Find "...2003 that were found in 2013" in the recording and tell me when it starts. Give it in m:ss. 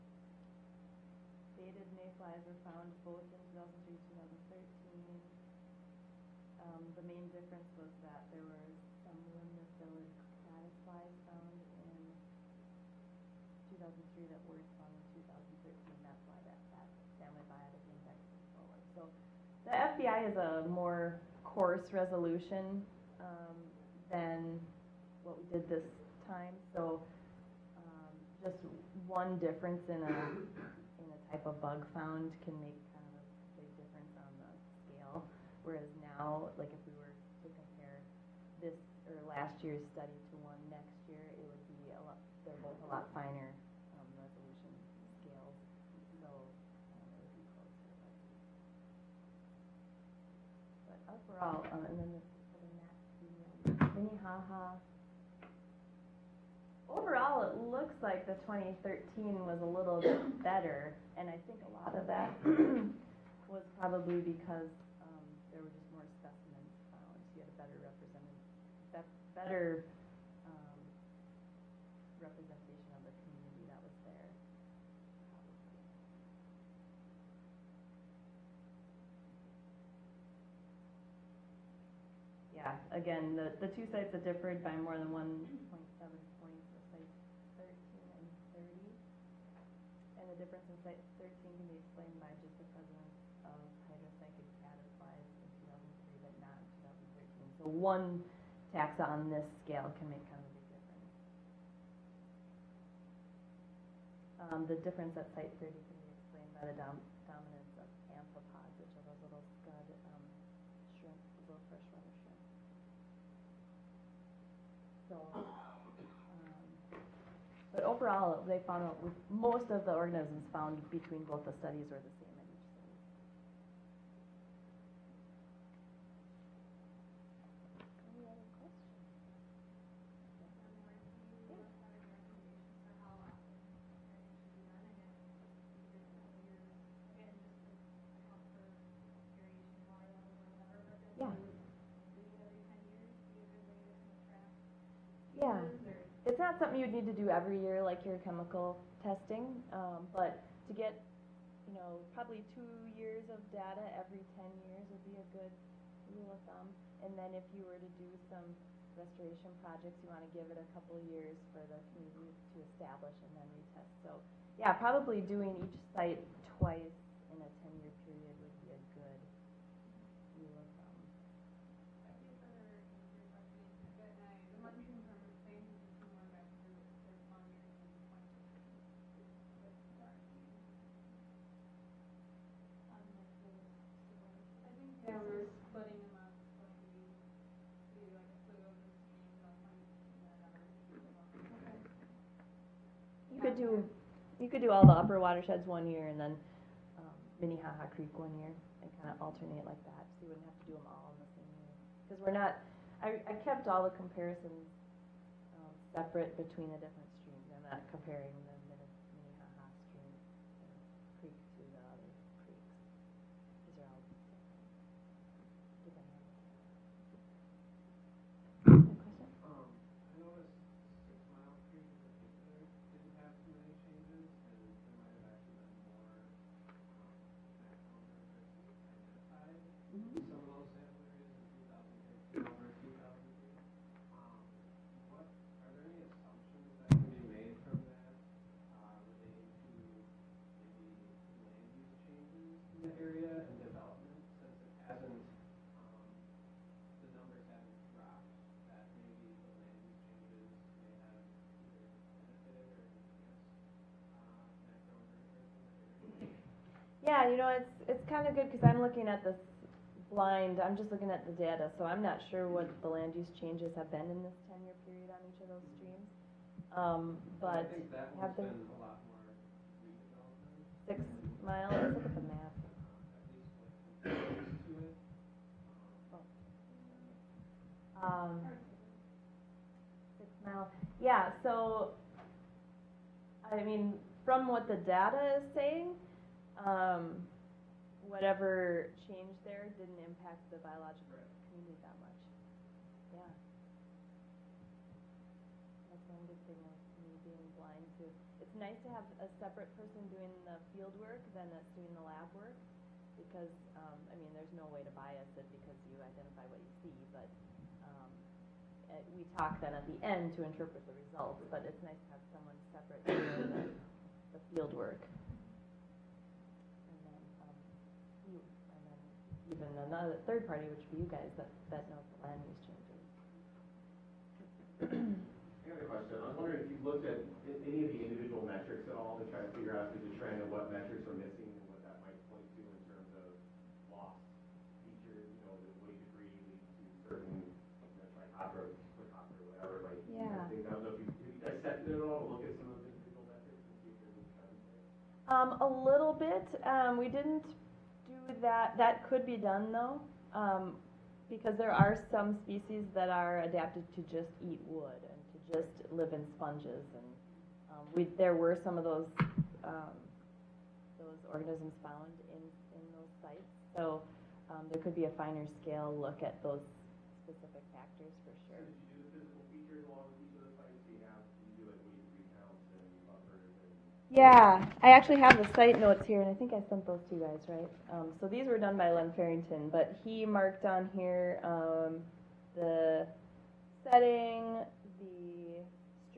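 0:13.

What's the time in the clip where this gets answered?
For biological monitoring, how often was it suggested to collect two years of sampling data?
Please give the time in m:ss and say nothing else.
2:34.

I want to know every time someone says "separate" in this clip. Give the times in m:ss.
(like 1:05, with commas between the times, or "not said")
3:25, 4:59, 5:12.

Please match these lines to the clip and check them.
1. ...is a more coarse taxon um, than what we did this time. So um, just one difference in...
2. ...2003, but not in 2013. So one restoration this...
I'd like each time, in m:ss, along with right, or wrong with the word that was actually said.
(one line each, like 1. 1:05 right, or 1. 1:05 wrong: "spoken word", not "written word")
1. 0:20 wrong: "resolution", not "taxon"
2. 1:35 wrong: "taxon", not "restoration".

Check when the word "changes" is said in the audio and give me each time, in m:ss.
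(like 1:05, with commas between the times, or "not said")
4:23, 4:49, 5:22.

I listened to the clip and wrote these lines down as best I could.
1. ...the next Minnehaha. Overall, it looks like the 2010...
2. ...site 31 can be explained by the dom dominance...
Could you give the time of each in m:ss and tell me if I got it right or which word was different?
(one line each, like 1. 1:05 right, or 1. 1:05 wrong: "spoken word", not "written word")
1. 0:52 wrong: "2013", not "2010"
2. 1:45 wrong: "30", not "31".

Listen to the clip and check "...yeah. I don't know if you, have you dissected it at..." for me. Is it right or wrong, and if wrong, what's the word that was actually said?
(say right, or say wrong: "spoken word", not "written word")
right.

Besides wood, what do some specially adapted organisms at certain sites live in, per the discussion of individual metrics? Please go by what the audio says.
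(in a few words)
sponges.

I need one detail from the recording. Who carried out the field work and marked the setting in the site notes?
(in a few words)
Len Ferrington.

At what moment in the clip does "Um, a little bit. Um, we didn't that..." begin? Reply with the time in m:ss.
5:45.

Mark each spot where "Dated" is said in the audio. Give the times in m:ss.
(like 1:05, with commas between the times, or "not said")
0:01.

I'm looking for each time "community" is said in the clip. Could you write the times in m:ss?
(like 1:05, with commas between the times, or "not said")
1:13, 2:41, 4:51.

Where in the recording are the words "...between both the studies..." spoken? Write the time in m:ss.
2:00.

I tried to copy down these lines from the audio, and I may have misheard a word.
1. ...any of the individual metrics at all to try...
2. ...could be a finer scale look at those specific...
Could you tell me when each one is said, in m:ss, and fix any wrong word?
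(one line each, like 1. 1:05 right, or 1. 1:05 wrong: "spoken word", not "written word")
1. 5:27 right
2. 6:04 right.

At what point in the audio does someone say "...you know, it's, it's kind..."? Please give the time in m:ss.
4:17.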